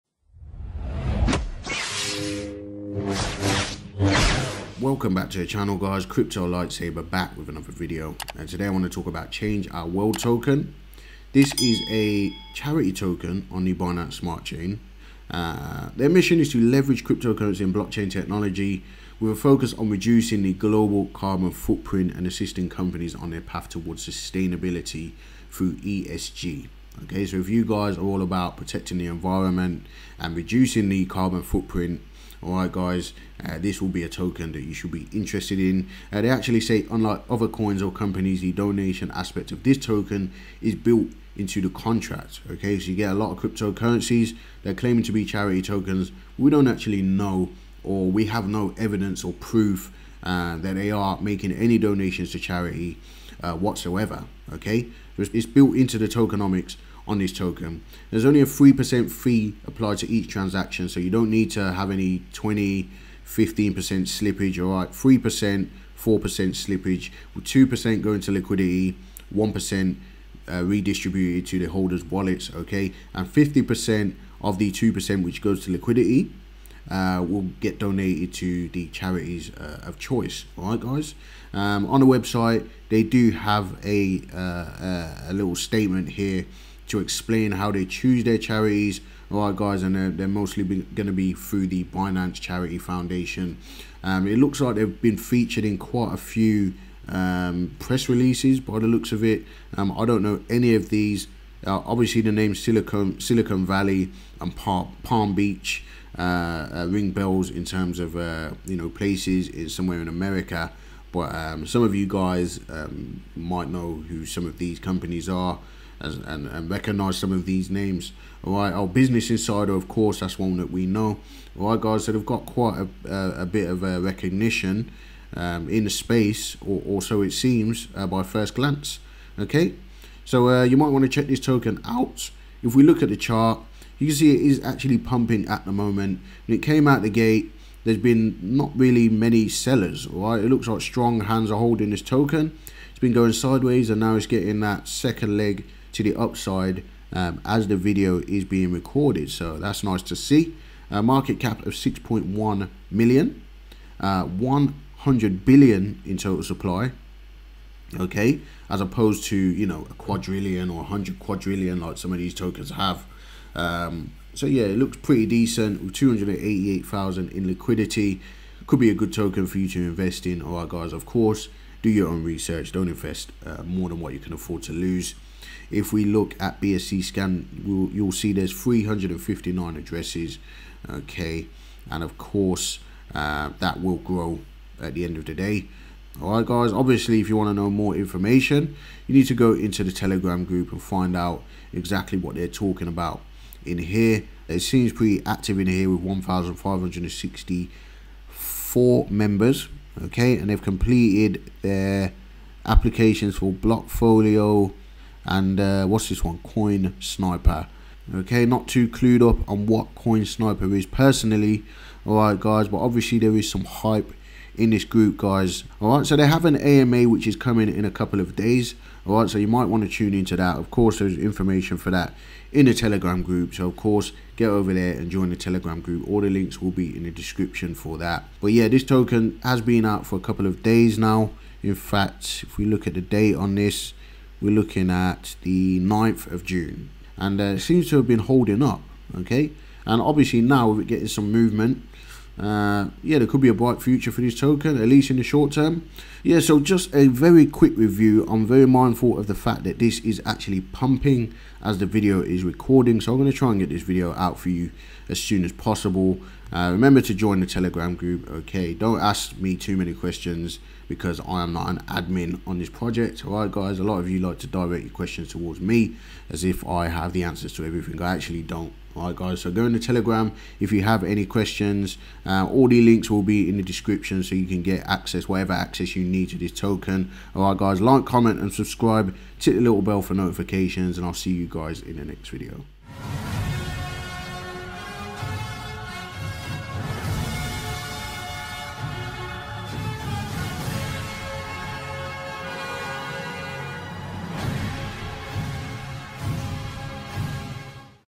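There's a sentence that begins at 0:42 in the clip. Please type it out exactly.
Okay, so you get a lot of cryptocurrencies.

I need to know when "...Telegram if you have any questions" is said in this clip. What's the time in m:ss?
4:29.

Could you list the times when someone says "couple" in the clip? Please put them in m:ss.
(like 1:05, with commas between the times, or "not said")
3:37, 3:50.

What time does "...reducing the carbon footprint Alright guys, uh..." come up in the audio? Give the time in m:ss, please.
0:30.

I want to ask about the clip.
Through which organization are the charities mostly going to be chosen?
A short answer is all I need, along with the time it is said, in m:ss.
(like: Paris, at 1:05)
Binance Charity Foundation, at 1:31.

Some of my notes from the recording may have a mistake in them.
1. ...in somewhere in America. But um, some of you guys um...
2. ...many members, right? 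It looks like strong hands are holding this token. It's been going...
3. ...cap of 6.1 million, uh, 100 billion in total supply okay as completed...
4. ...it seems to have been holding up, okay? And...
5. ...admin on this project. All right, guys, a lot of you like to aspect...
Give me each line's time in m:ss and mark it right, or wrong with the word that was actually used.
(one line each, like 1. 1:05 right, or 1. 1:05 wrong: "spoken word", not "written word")
1. 1:49 right
2. 2:19 wrong: "sellers", not "members"
3. 2:31 wrong: "opposed", not "completed"
4. 3:57 right
5. 4:21 wrong: "direct", not "aspect".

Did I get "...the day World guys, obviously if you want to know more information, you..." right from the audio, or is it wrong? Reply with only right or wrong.
wrong.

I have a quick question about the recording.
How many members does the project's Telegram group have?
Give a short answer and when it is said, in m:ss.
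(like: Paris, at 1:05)
1,564, at 3:16.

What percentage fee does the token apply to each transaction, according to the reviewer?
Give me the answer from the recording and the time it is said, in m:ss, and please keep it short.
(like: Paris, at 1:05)
3%, at 0:58.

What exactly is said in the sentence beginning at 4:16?
Uh, remember to join the Telegram group, okay?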